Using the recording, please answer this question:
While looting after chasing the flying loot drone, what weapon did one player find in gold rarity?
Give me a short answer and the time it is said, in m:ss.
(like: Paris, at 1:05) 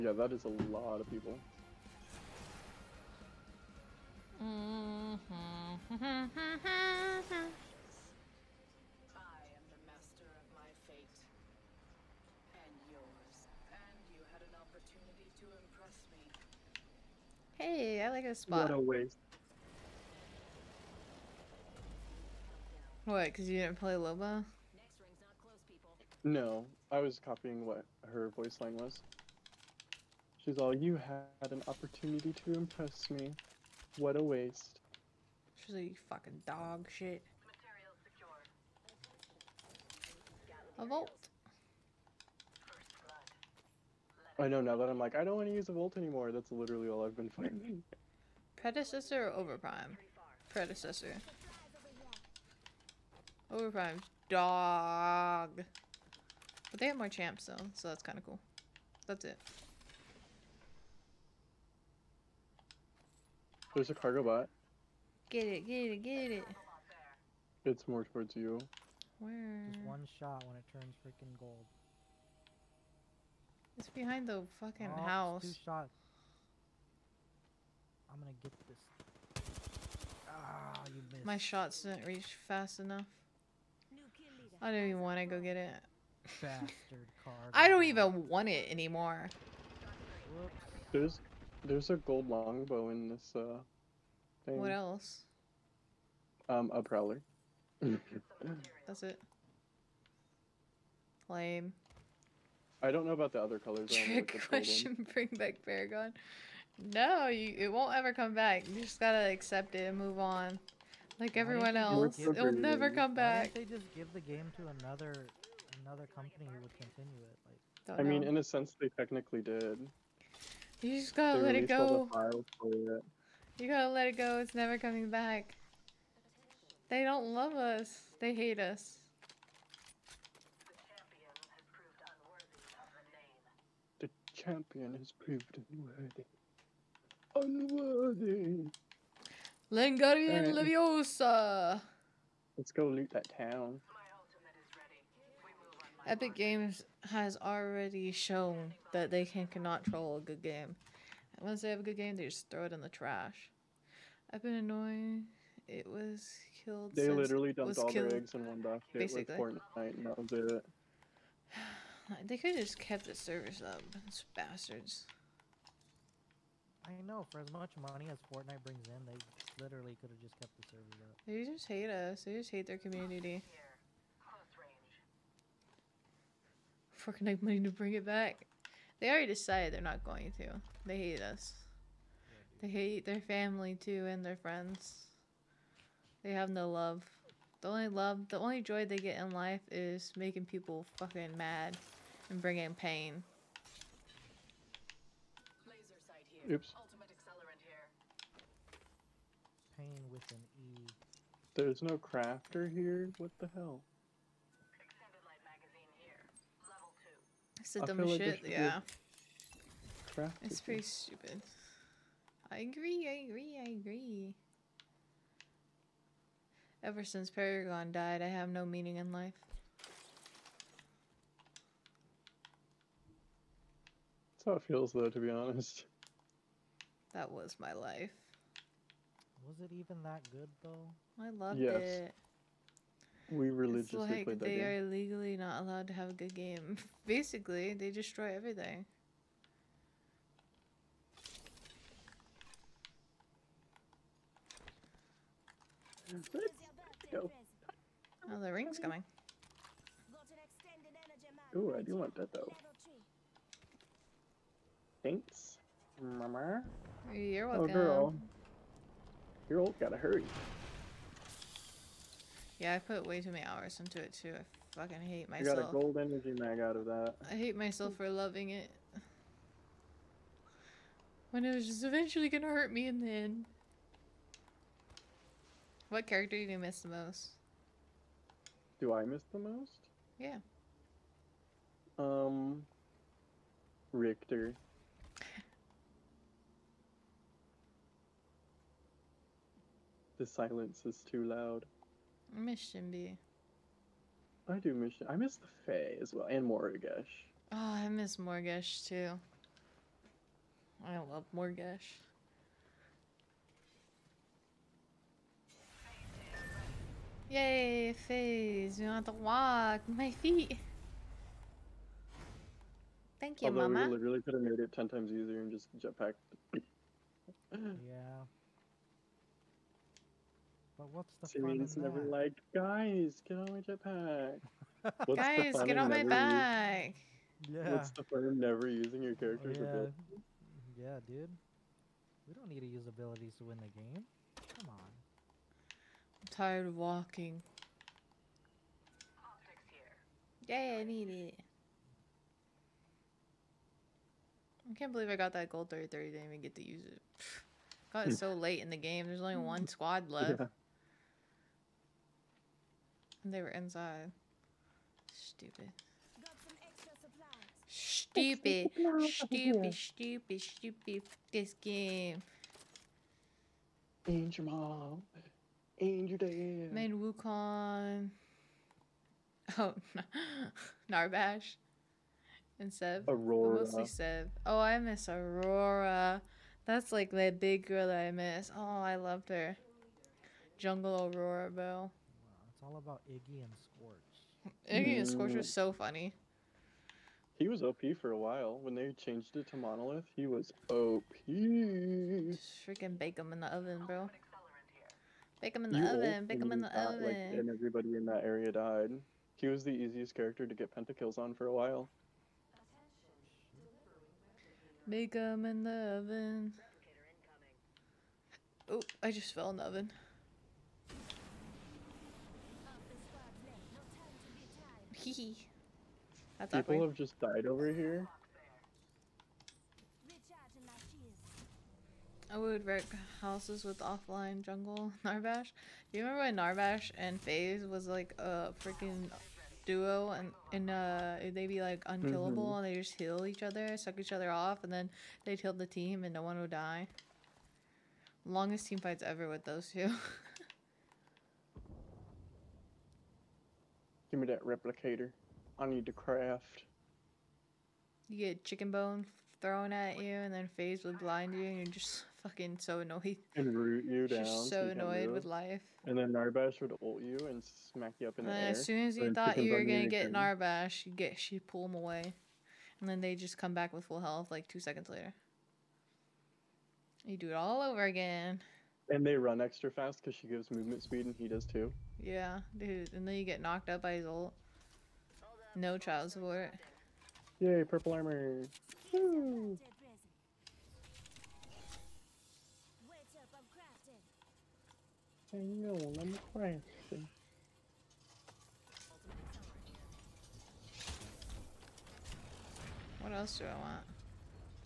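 Longbow, at 1:31.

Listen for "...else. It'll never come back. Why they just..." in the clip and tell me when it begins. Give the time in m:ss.
1:51.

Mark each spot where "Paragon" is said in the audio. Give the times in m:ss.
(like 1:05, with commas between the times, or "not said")
1:45, 3:37.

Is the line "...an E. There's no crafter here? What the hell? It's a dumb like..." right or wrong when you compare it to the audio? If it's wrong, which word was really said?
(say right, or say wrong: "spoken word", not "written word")
right.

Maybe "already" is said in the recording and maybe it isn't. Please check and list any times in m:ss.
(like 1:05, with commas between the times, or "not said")
2:27, 2:59.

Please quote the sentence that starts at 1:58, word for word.
mean, in a sense, they technically did.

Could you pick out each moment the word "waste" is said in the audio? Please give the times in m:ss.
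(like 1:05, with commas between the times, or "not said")
0:18, 0:34.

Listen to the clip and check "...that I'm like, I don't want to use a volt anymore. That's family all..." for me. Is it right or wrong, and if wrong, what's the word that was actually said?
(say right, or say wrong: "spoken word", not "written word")
wrong: "literally", not "family".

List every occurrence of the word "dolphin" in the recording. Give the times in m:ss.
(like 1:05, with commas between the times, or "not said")
not said.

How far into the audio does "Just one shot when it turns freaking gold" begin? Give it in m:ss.
1:09.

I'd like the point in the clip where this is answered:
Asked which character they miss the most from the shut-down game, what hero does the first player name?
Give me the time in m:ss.
4:43.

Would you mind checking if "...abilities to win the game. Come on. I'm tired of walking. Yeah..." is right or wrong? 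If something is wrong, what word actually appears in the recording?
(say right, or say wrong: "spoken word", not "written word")
right.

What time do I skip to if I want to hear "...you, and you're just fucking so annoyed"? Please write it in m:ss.
7:31.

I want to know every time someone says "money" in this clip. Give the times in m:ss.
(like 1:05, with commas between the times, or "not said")
2:47, 2:57.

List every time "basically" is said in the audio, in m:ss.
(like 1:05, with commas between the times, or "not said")
2:38, 3:57.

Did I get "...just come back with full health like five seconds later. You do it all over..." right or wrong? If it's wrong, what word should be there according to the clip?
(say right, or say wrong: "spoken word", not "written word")
wrong: "two", not "five".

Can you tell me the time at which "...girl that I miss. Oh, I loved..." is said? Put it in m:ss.
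6:17.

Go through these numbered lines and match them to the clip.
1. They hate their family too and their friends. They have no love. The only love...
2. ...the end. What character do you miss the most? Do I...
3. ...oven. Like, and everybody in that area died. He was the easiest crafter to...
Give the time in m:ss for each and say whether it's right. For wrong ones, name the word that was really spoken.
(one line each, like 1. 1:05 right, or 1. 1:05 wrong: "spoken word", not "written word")
1. 3:02 right
2. 4:33 right
3. 6:36 wrong: "character", not "crafter".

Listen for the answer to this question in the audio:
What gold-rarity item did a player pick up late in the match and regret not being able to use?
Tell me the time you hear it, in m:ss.
5:45.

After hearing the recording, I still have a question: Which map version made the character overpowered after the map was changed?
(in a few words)
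Monolith.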